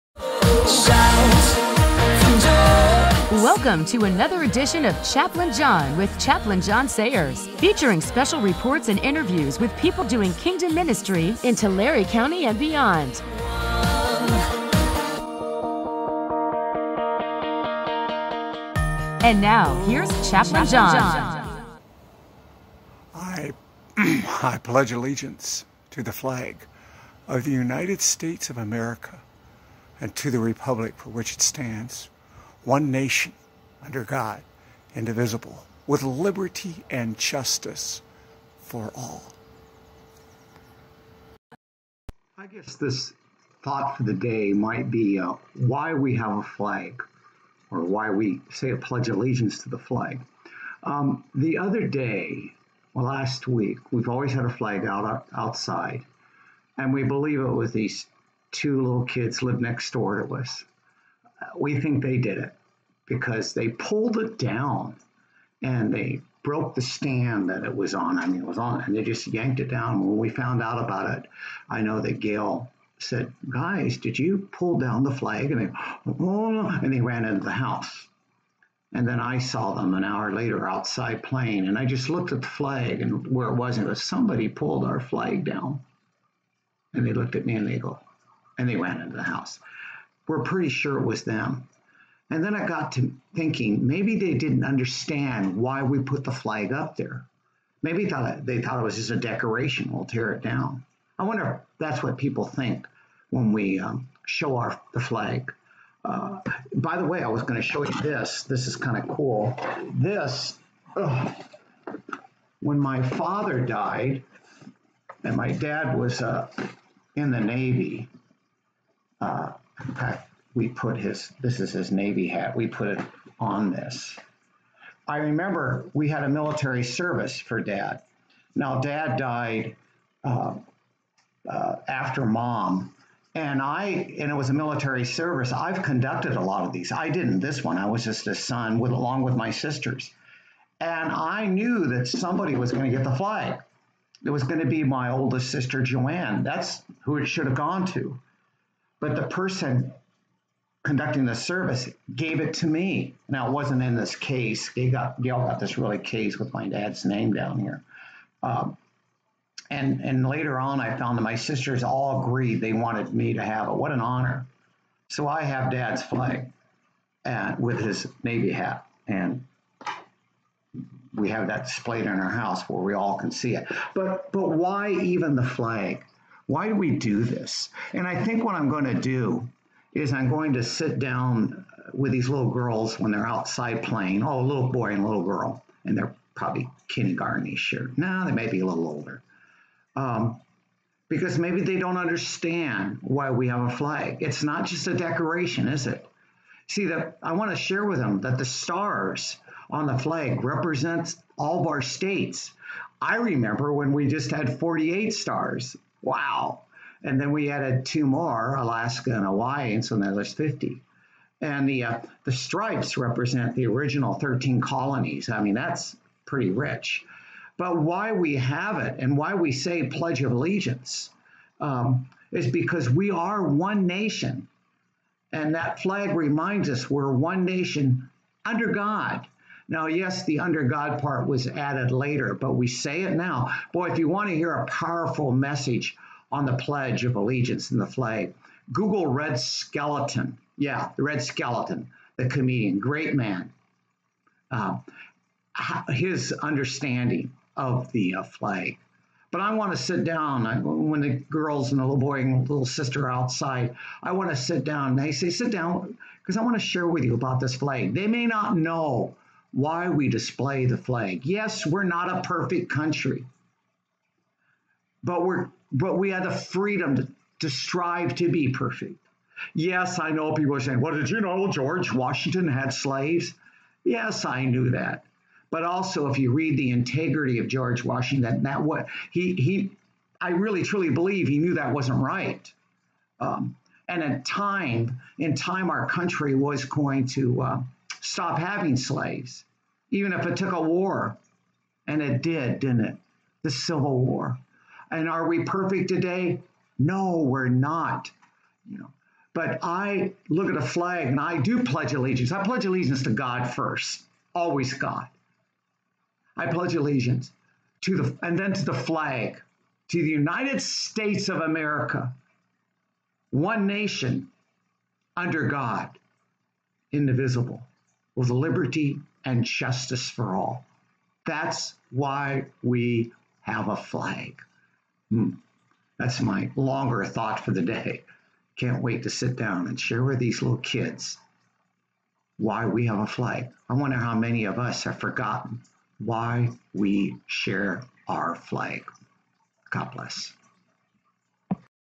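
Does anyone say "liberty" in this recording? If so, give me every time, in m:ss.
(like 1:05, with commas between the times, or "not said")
0:36, 5:18.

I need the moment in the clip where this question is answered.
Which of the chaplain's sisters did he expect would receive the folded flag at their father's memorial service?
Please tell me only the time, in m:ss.
2:25.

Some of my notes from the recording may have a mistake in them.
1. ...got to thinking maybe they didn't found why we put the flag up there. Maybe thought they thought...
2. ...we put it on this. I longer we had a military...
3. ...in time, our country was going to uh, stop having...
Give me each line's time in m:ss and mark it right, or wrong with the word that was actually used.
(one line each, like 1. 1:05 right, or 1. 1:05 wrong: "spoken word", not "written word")
1. 1:32 wrong: "understand", not "found"
2. 2:02 wrong: "remember", not "longer"
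3. 4:45 right.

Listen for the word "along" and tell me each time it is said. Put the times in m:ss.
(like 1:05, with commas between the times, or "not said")
2:18.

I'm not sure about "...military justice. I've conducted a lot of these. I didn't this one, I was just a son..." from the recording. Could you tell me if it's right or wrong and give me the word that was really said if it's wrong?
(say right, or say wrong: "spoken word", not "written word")
wrong: "service", not "justice".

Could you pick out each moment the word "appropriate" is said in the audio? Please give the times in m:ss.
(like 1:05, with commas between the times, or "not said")
not said.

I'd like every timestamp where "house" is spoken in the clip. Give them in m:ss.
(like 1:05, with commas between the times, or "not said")
1:17, 1:29, 2:52.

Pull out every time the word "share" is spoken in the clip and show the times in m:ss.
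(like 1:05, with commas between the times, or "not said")
3:17, 4:16, 5:29, 5:37.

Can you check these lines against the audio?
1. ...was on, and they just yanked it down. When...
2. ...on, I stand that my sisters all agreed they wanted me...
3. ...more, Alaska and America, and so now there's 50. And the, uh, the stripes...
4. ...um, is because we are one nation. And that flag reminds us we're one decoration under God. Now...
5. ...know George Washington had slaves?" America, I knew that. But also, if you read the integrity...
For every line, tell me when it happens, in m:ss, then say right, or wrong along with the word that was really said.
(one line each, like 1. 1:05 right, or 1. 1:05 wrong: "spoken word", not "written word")
1. 1:08 right
2. 2:40 wrong: "found", not "stand"
3. 3:28 wrong: "Hawaii", not "America"
4. 3:41 wrong: "nation", not "decoration"
5. 4:31 wrong: "Yes", not "America".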